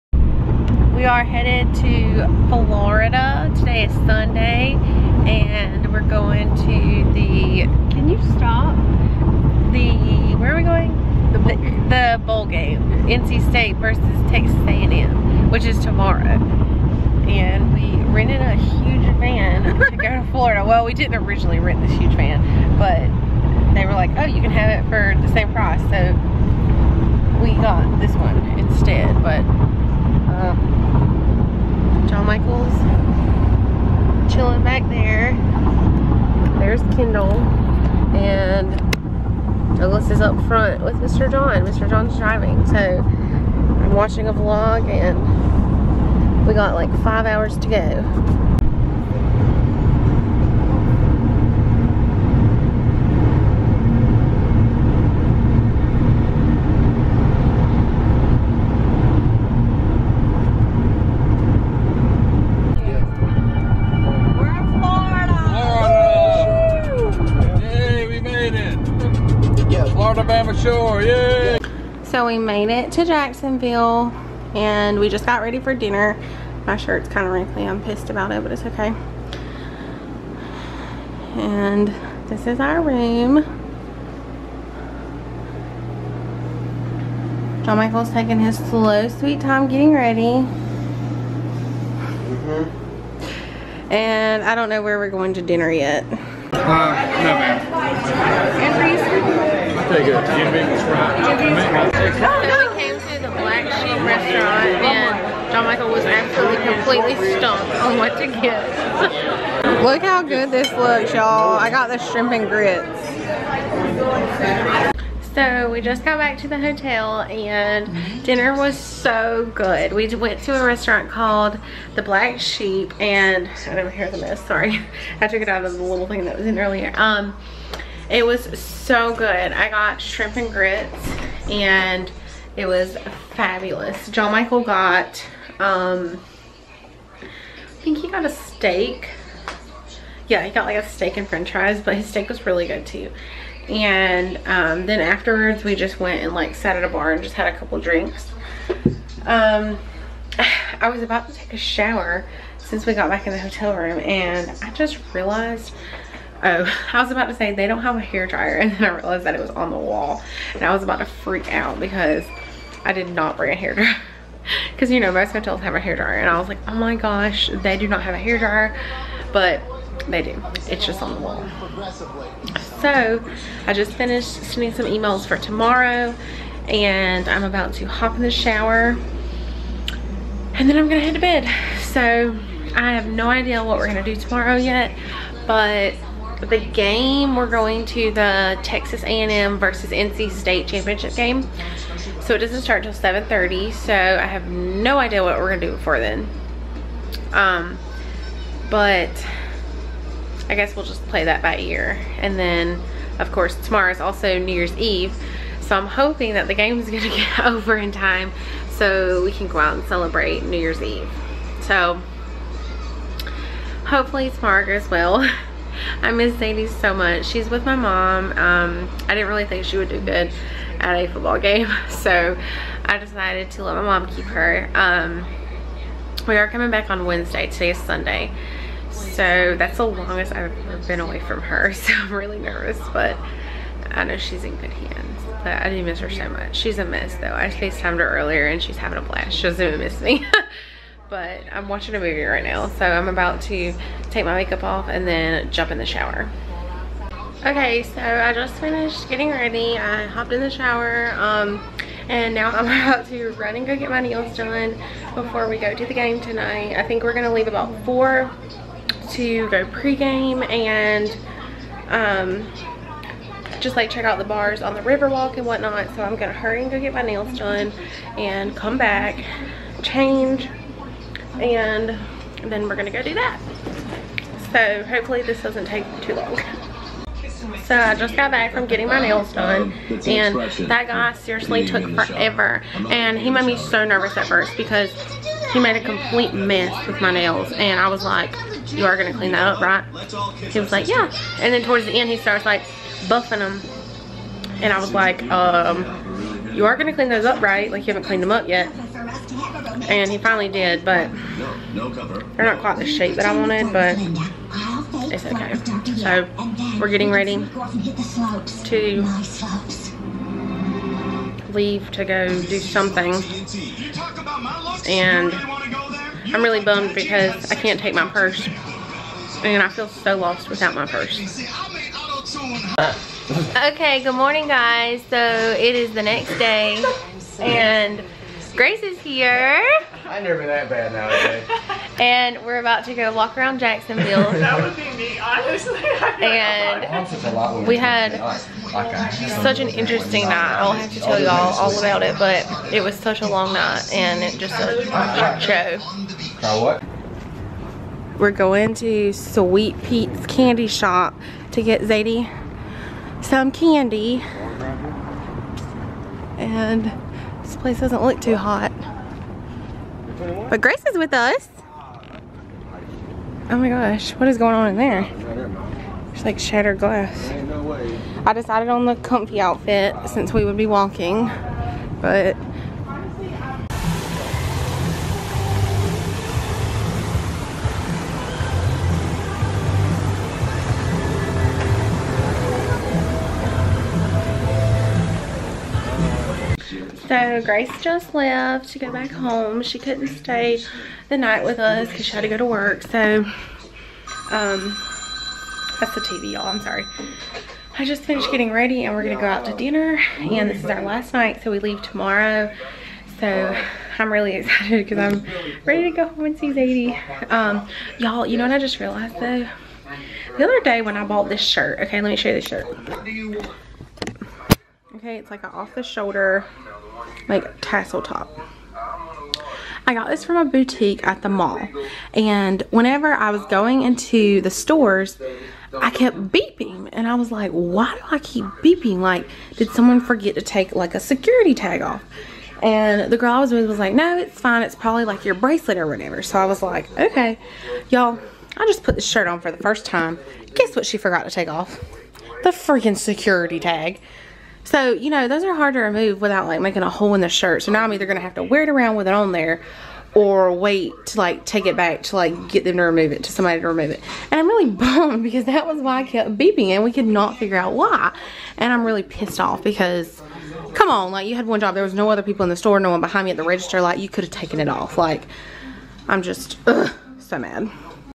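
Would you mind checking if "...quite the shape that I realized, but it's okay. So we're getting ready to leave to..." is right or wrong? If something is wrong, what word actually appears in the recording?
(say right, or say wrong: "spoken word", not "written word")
wrong: "wanted", not "realized".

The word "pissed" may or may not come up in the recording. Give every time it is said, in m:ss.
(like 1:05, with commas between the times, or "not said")
1:17, 7:39.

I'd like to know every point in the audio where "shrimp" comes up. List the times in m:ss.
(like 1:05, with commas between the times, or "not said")
1:51, 2:10.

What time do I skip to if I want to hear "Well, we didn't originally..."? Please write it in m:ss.
0:20.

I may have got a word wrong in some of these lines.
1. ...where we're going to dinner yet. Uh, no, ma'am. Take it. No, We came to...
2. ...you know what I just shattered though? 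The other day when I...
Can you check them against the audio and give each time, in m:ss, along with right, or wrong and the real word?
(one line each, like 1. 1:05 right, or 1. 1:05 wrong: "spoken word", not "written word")
1. 1:34 right
2. 6:48 wrong: "realized", not "shattered".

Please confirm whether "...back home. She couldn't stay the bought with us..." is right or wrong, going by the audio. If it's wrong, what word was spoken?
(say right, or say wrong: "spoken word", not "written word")
wrong: "night", not "bought".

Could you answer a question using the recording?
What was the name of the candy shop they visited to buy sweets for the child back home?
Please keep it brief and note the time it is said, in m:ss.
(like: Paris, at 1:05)
Sweet Pete's Candy Shop, at 5:49.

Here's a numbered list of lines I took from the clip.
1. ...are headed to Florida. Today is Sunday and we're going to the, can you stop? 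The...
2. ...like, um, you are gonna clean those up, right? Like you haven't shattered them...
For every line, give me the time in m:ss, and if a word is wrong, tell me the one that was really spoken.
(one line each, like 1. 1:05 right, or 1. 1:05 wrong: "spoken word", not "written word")
1. 0:01 right
2. 4:54 wrong: "cleaned", not "shattered".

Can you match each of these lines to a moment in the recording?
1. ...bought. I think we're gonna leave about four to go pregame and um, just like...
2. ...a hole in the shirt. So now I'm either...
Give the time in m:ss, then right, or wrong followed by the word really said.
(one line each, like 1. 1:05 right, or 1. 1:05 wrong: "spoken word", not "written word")
1. 4:16 wrong: "tonight", not "bought"
2. 7:26 right.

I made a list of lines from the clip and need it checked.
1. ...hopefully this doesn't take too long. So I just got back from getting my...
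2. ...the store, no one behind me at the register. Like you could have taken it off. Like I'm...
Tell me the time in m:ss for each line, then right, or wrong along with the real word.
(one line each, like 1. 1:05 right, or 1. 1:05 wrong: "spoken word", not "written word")
1. 4:34 right
2. 7:42 right.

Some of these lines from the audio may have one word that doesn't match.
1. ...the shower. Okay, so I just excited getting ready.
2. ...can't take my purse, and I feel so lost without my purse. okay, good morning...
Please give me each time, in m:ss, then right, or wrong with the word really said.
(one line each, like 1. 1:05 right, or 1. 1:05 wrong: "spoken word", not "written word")
1. 4:05 wrong: "finished", not "excited"
2. 5:17 right.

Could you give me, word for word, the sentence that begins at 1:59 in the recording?
We went to a restaurant called The Black Sheep and I don't hear the mess, sorry.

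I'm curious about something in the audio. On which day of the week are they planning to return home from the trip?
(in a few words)
Wednesday.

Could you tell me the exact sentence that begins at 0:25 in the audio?
So we got this one instead, but um, Michael's chilling back there.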